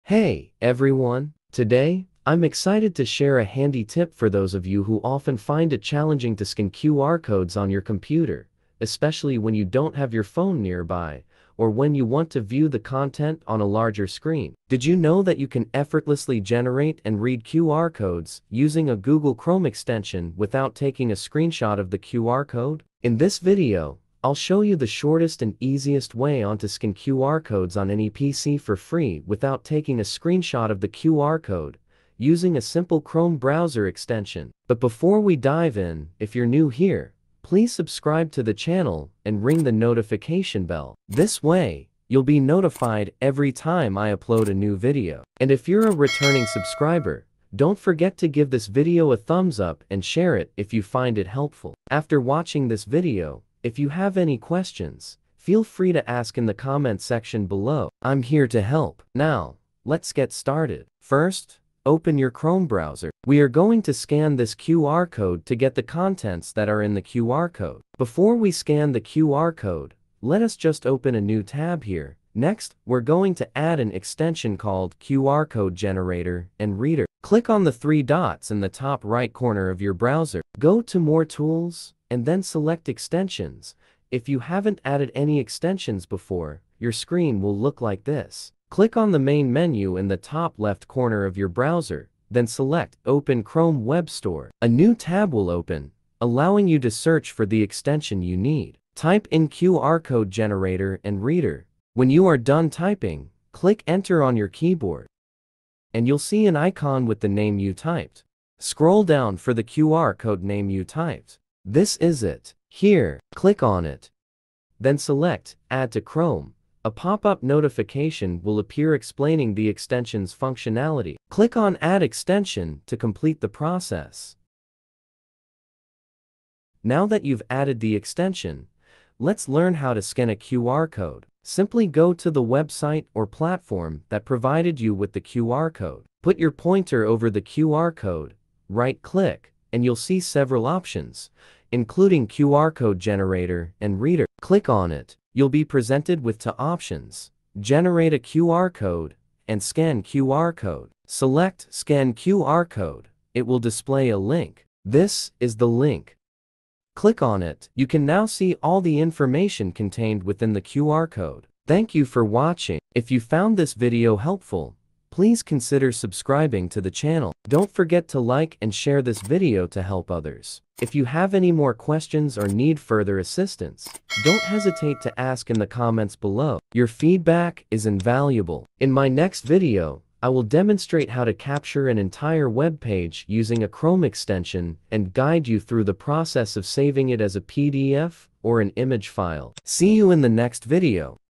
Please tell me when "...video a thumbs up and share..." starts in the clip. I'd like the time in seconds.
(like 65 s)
48 s.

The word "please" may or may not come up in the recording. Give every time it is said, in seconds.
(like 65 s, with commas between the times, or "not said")
37 s, 165 s.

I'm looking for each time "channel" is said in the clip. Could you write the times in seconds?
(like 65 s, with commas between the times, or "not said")
38 s, 166 s.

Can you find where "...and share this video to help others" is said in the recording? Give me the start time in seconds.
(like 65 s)
168 s.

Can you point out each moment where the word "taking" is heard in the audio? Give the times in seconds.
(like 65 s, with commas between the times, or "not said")
20 s, 29 s.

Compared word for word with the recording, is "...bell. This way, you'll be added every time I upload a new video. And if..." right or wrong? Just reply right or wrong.
wrong.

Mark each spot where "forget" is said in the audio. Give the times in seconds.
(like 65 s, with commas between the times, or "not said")
47 s, 167 s.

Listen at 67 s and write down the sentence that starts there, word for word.
Before we scan the QR code, let us just open a new tab here.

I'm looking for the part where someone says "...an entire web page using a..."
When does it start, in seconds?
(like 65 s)
181 s.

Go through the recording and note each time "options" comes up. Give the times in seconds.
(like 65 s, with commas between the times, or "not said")
140 s, 146 s.